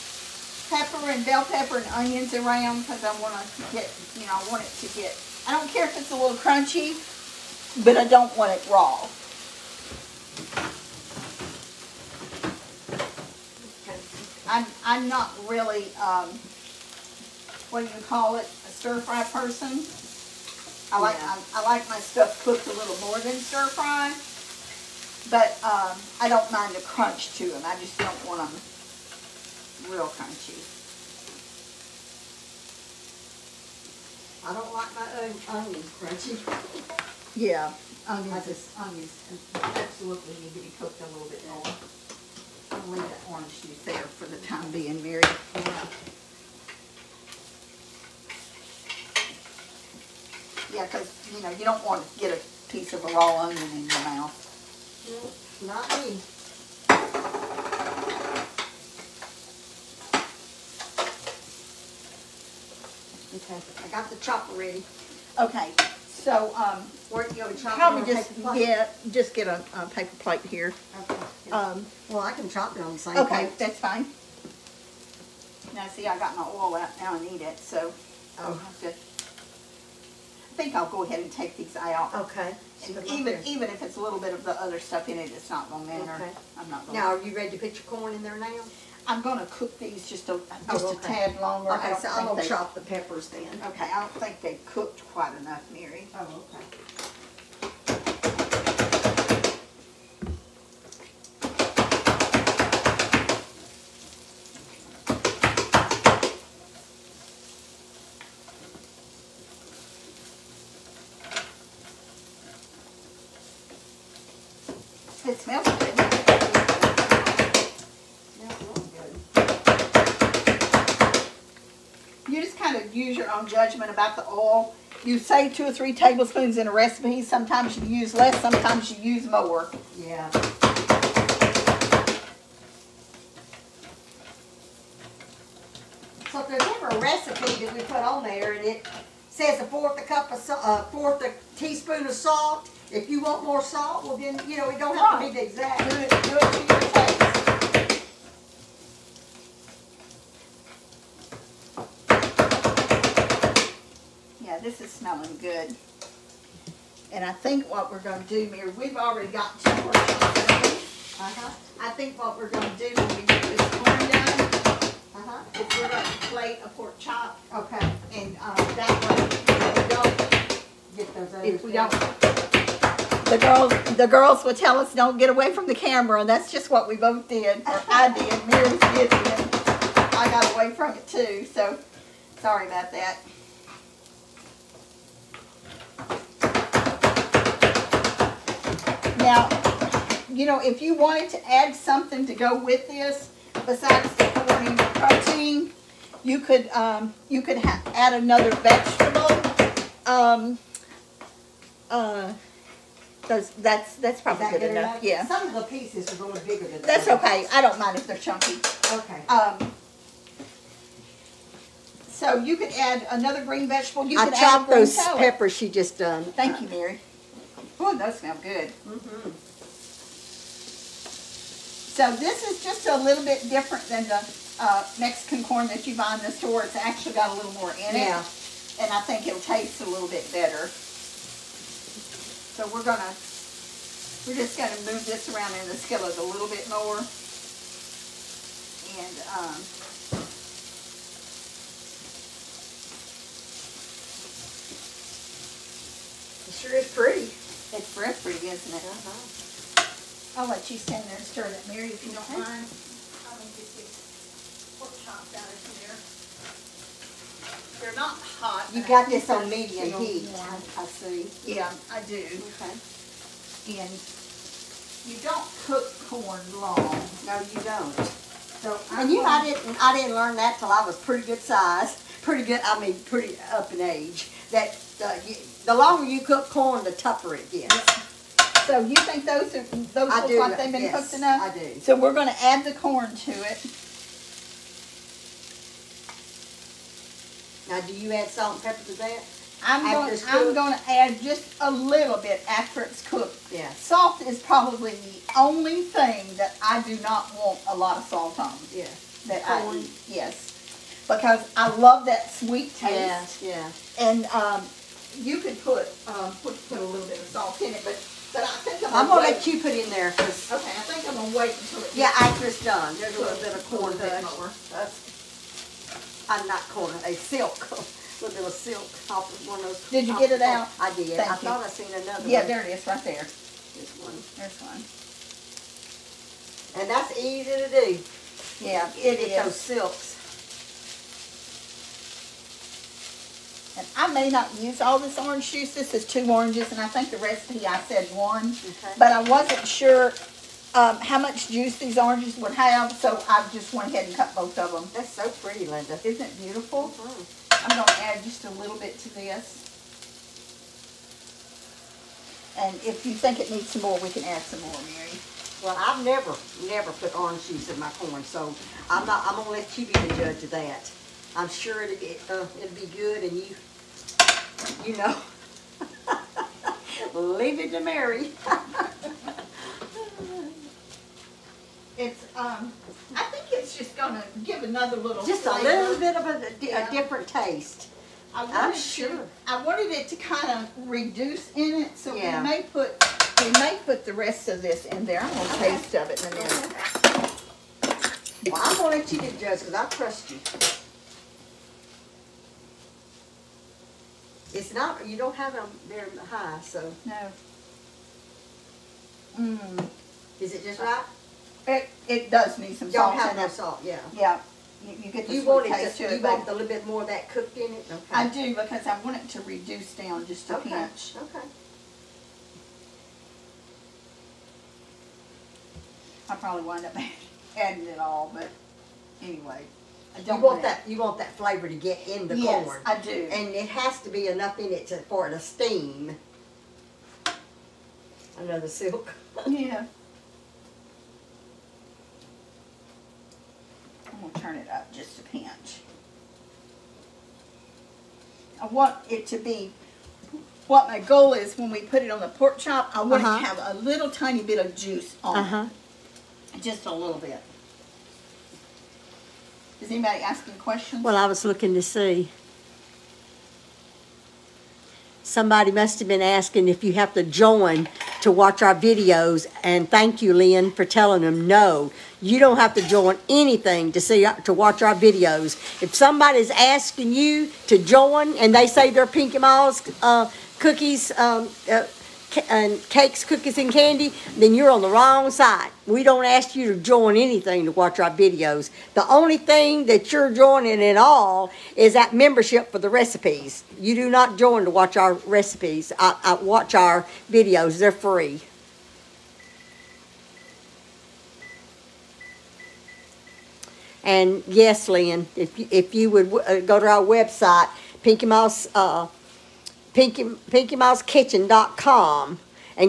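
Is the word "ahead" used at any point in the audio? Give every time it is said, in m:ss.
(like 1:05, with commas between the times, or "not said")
1:21, 5:43.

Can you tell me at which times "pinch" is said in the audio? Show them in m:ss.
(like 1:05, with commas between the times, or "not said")
6:50, 7:15.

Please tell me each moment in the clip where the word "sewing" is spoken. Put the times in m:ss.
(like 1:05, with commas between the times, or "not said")
not said.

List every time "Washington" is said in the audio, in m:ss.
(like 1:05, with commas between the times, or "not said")
not said.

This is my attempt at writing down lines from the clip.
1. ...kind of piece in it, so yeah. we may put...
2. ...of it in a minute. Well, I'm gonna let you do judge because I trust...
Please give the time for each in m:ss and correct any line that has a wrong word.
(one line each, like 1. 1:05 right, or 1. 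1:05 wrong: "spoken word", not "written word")
1. 6:20 wrong: "reduce", not "piece"
2. 6:25 right.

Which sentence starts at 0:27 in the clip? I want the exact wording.
I just don't want them real crunchy.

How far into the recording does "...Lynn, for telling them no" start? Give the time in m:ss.
7:40.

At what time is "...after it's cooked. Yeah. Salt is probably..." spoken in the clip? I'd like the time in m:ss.
4:52.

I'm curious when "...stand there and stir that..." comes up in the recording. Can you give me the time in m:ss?
4:10.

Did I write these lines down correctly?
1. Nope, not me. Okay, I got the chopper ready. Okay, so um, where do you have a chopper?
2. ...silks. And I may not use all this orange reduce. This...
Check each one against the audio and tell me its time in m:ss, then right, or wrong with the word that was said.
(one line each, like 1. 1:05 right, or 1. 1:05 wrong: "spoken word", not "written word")
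1. 0:55 right
2. 5:29 wrong: "juice", not "reduce".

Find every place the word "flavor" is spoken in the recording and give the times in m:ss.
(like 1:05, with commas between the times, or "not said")
6:15, 7:01.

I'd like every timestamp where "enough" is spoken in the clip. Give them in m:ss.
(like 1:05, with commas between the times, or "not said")
1:35, 3:24, 4:41, 7:04.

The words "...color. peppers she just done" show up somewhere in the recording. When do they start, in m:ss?
3:34.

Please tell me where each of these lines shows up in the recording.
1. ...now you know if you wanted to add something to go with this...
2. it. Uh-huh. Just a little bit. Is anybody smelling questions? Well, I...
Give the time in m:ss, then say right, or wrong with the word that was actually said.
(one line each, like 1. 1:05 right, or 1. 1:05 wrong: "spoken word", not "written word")
1. 3:09 right
2. 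7:25 wrong: "asking", not "smelling".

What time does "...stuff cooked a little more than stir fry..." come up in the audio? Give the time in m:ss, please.
0:21.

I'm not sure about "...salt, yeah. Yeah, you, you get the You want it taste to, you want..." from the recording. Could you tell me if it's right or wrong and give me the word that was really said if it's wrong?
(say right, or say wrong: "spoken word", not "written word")
right.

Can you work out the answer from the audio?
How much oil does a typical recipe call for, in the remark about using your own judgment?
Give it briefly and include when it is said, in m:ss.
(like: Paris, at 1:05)
2 or 3 tablespoons, at 2:05.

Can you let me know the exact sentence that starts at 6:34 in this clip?
It's not you don't have them very high, so no.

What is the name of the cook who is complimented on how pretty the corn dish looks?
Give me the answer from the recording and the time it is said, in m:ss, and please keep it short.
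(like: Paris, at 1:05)
Linda, at 5:45.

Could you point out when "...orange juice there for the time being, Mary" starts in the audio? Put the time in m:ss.
0:43.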